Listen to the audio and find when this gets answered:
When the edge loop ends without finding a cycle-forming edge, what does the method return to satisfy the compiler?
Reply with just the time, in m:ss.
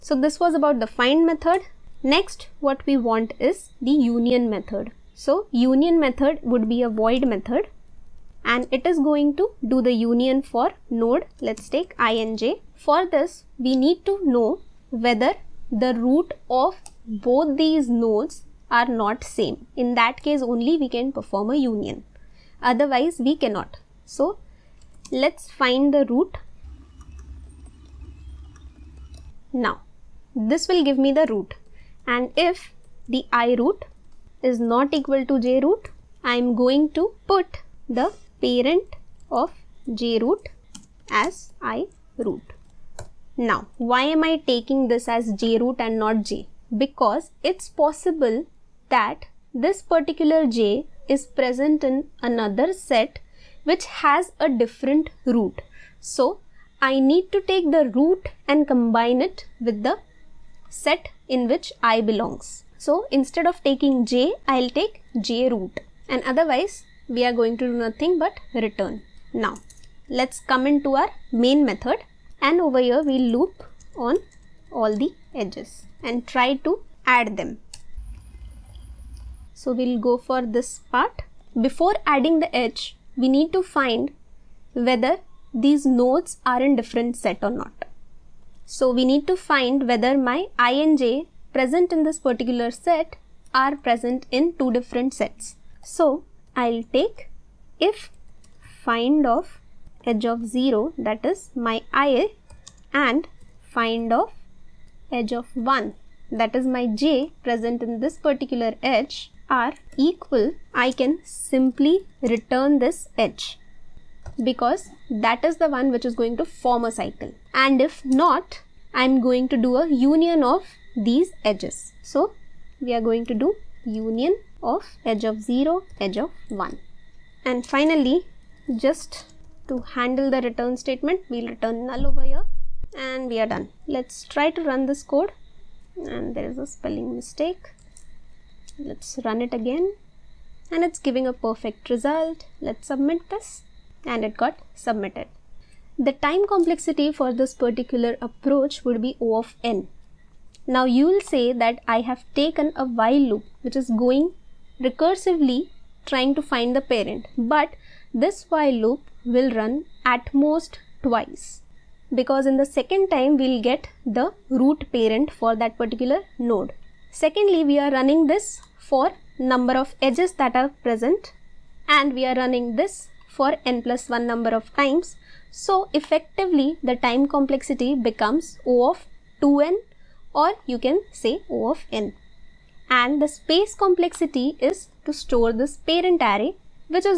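2:11.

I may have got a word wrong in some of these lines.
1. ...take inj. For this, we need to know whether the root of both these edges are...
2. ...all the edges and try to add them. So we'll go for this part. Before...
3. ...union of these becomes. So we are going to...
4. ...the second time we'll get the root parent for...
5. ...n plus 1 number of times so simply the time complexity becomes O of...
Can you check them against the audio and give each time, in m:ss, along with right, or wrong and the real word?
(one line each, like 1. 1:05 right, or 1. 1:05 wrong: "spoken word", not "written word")
1. 0:11 wrong: "nodes", not "edges"
2. 1:14 right
3. 1:59 wrong: "edges", not "becomes"
4. 2:42 right
5. 2:53 wrong: "effectively", not "simply".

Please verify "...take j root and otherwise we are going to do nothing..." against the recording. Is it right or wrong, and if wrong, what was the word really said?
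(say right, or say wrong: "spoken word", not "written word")
right.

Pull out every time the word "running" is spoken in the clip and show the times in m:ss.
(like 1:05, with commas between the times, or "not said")
2:47, 2:52.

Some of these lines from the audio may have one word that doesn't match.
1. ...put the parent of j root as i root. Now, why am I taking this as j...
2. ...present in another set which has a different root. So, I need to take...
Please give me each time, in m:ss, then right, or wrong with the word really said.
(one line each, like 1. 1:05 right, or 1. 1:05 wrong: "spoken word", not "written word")
1. 0:37 right
2. 0:51 right.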